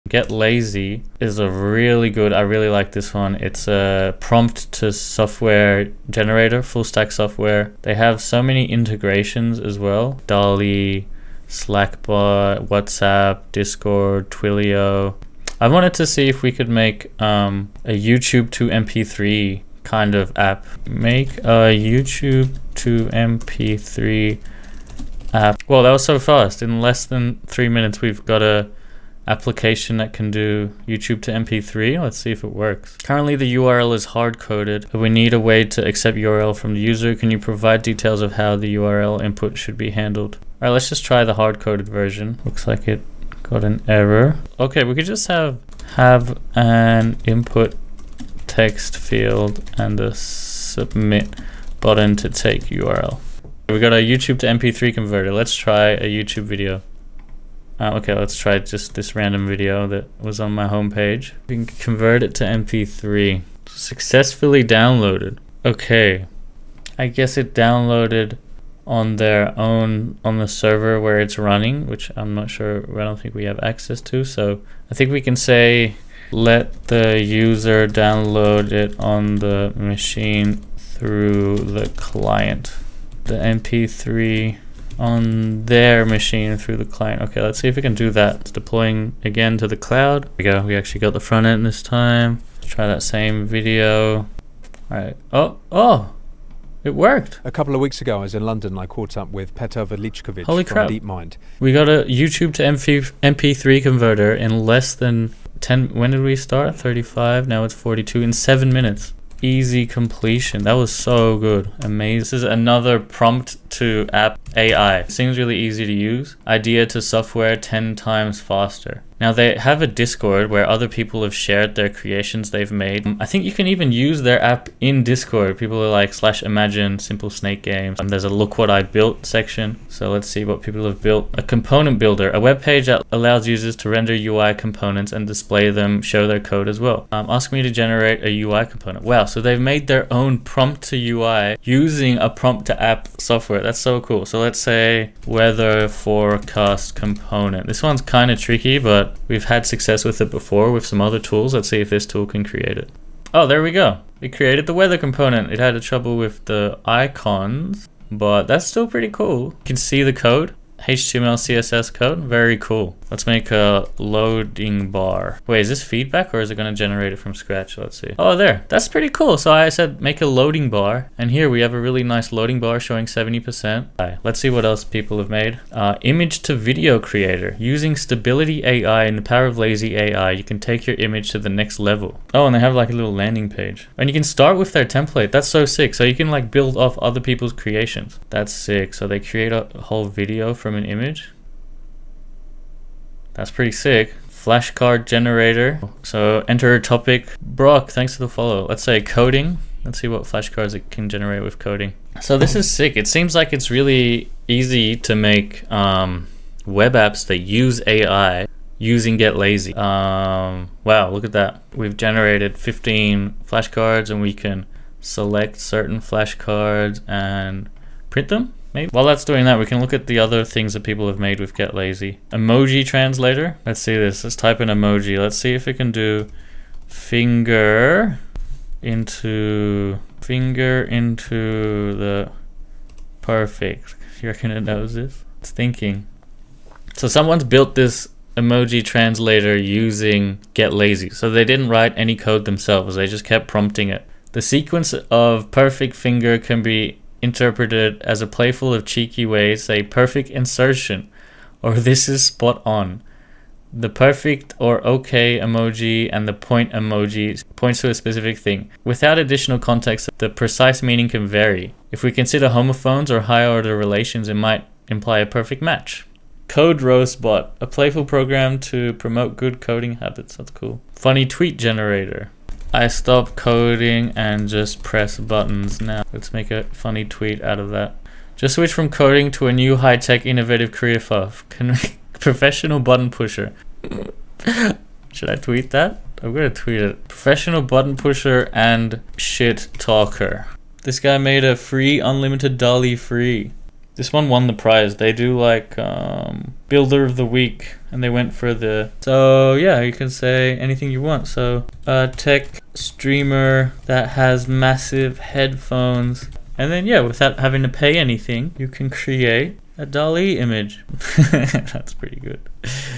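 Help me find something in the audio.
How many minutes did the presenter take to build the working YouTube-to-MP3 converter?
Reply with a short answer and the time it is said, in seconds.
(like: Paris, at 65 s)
7, at 108 s.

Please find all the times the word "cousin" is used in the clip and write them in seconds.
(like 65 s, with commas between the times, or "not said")
not said.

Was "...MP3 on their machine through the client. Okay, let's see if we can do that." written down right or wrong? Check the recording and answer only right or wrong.
right.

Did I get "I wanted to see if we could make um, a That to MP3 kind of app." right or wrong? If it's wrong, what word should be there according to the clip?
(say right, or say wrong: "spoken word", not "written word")
wrong: "YouTube", not "That".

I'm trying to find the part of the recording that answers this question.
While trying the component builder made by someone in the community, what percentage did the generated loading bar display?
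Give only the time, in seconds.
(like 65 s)
173 s.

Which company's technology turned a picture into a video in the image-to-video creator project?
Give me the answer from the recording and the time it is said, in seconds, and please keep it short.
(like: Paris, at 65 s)
Stability AI, at 177 s.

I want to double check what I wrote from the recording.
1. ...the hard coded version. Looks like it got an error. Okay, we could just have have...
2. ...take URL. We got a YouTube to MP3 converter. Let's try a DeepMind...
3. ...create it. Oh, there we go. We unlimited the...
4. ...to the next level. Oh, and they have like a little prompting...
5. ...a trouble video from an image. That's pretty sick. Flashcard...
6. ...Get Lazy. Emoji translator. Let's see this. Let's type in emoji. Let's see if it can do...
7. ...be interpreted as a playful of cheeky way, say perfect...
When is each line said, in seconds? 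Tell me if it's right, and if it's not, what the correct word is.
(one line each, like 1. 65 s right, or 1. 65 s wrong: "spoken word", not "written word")
1. 41 s right
2. 52 s wrong: "YouTube", not "DeepMind"
3. 152 s wrong: "created", not "unlimited"
4. 181 s wrong: "landing", not "prompting"
5. 189 s wrong: "whole", not "trouble"
6. 221 s right
7. 246 s right.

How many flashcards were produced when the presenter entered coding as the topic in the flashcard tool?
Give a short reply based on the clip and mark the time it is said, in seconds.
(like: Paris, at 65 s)
15, at 212 s.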